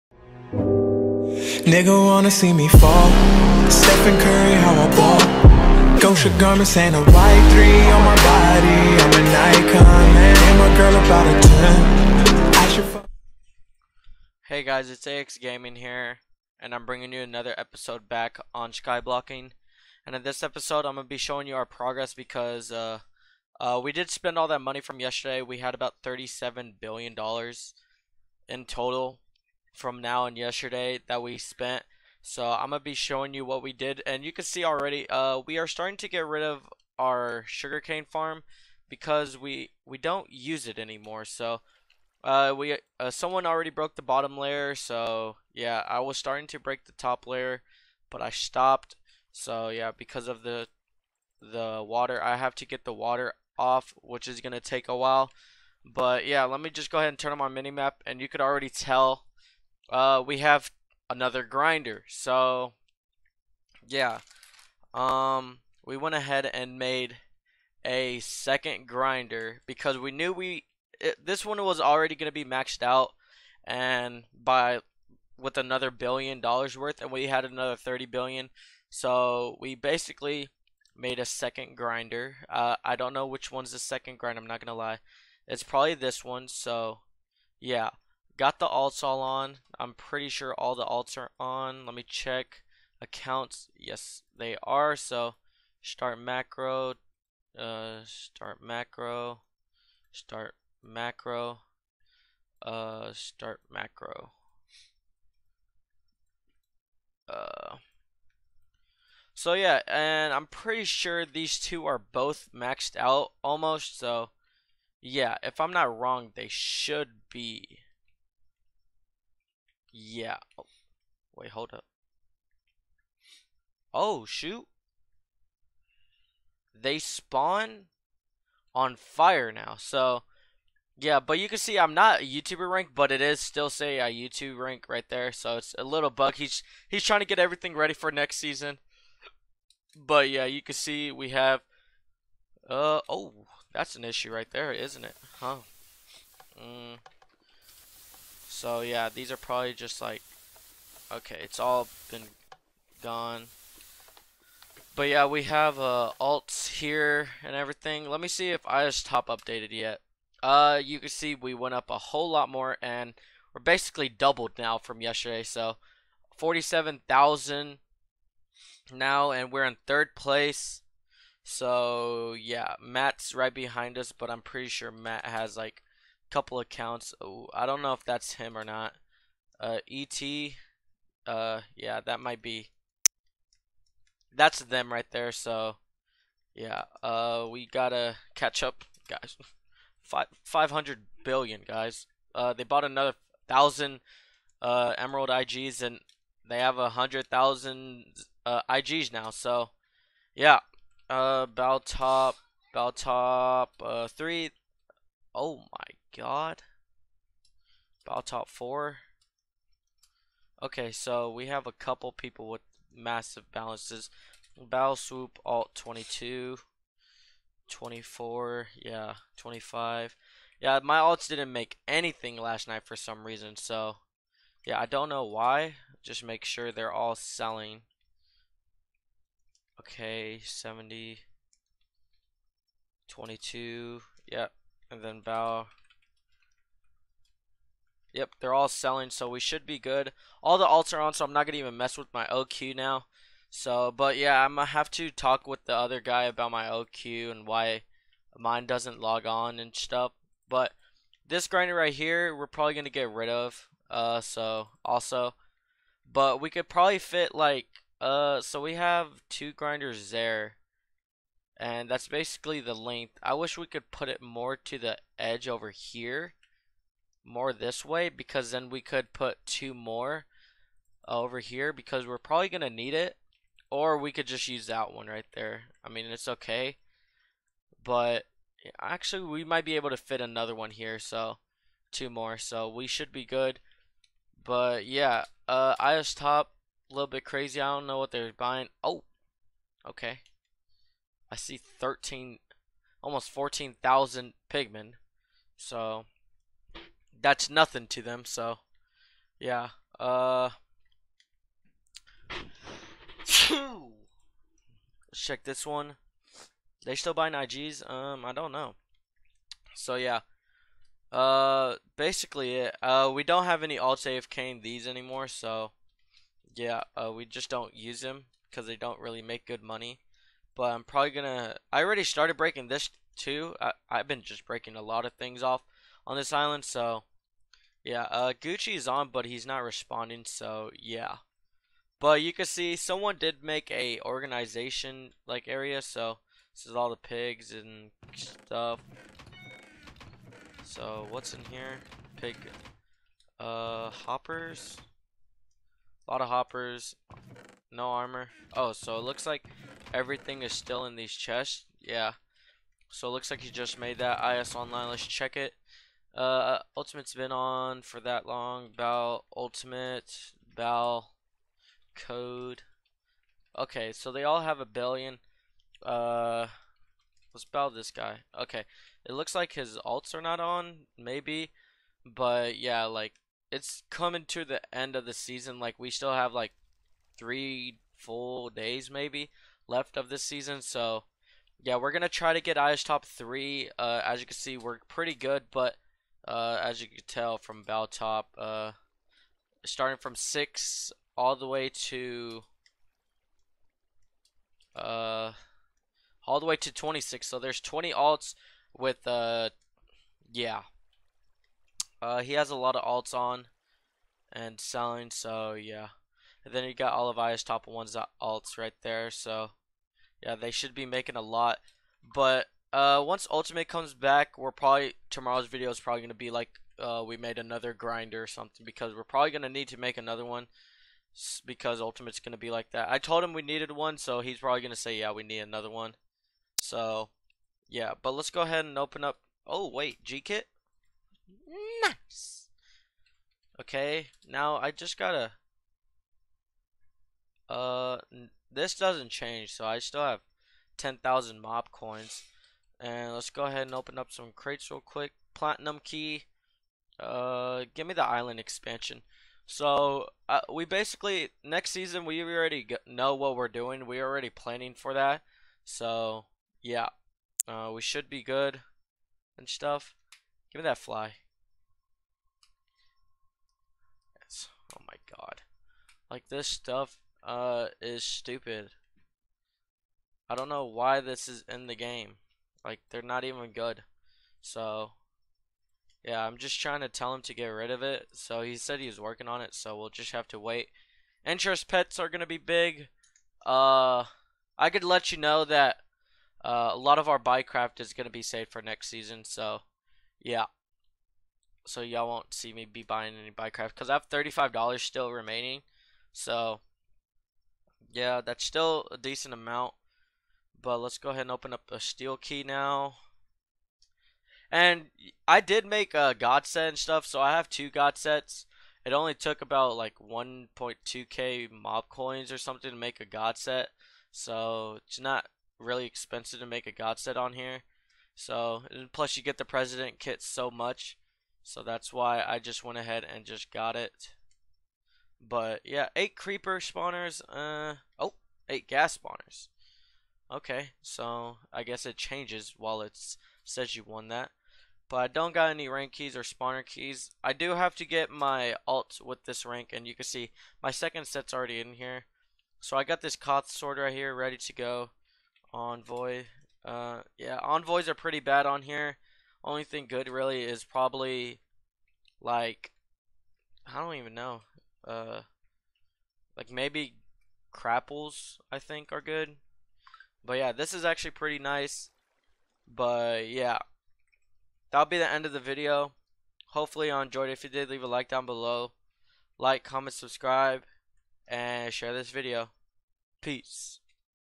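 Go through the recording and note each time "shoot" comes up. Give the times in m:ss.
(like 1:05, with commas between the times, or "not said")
2:04.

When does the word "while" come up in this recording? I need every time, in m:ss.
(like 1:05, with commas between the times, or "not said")
0:54, 8:52.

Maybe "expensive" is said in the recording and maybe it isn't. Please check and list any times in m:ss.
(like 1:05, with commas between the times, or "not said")
8:35.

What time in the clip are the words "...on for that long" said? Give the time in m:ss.
5:57.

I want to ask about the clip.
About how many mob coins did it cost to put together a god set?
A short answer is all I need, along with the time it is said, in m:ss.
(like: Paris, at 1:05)
1.2k, at 8:29.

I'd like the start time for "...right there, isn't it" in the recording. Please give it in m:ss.
2:24.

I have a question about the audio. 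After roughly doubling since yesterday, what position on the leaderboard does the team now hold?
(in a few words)
third place.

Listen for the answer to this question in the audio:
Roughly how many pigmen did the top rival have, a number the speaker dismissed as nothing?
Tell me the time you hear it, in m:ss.
4:53.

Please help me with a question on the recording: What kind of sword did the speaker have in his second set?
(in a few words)
Koth sword.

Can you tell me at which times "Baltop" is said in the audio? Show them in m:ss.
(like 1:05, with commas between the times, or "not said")
3:22, 6:27.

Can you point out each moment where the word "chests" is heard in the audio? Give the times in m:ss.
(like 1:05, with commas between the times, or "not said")
5:51.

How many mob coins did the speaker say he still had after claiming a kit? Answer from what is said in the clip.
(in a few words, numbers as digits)
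10,000.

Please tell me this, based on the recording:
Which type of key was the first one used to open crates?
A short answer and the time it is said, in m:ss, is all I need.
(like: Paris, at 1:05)
Platinum key, at 7:25.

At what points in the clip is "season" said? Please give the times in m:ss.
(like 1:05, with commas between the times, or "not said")
2:18, 6:15, 6:20, 7:31, 8:08.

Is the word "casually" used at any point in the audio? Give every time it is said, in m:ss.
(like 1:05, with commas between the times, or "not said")
not said.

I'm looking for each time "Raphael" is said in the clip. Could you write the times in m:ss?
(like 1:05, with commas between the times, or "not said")
not said.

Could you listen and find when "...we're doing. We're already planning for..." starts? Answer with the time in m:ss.
7:33.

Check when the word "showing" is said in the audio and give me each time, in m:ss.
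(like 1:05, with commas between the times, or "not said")
0:21, 0:32.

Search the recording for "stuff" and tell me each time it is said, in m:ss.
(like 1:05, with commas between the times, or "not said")
4:09, 5:38, 7:39, 7:46, 8:26.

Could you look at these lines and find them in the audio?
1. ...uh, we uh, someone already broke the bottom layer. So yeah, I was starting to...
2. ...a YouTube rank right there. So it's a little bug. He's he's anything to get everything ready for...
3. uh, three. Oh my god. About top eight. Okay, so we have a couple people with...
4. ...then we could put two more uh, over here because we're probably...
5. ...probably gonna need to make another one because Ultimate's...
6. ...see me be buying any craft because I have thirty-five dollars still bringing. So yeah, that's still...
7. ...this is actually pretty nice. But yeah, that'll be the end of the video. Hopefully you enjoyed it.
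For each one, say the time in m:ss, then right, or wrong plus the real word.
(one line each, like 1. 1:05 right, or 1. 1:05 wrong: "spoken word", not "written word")
1. 0:42 right
2. 2:13 wrong: "trying", not "anything"
3. 3:23 wrong: "four", not "eight"
4. 4:28 right
5. 6:59 right
6. 8:12 wrong: "remaining", not "bringing"
7. 9:20 right.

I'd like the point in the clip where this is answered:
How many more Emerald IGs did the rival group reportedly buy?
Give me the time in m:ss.
3:12.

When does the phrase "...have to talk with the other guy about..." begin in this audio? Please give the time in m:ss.
4:04.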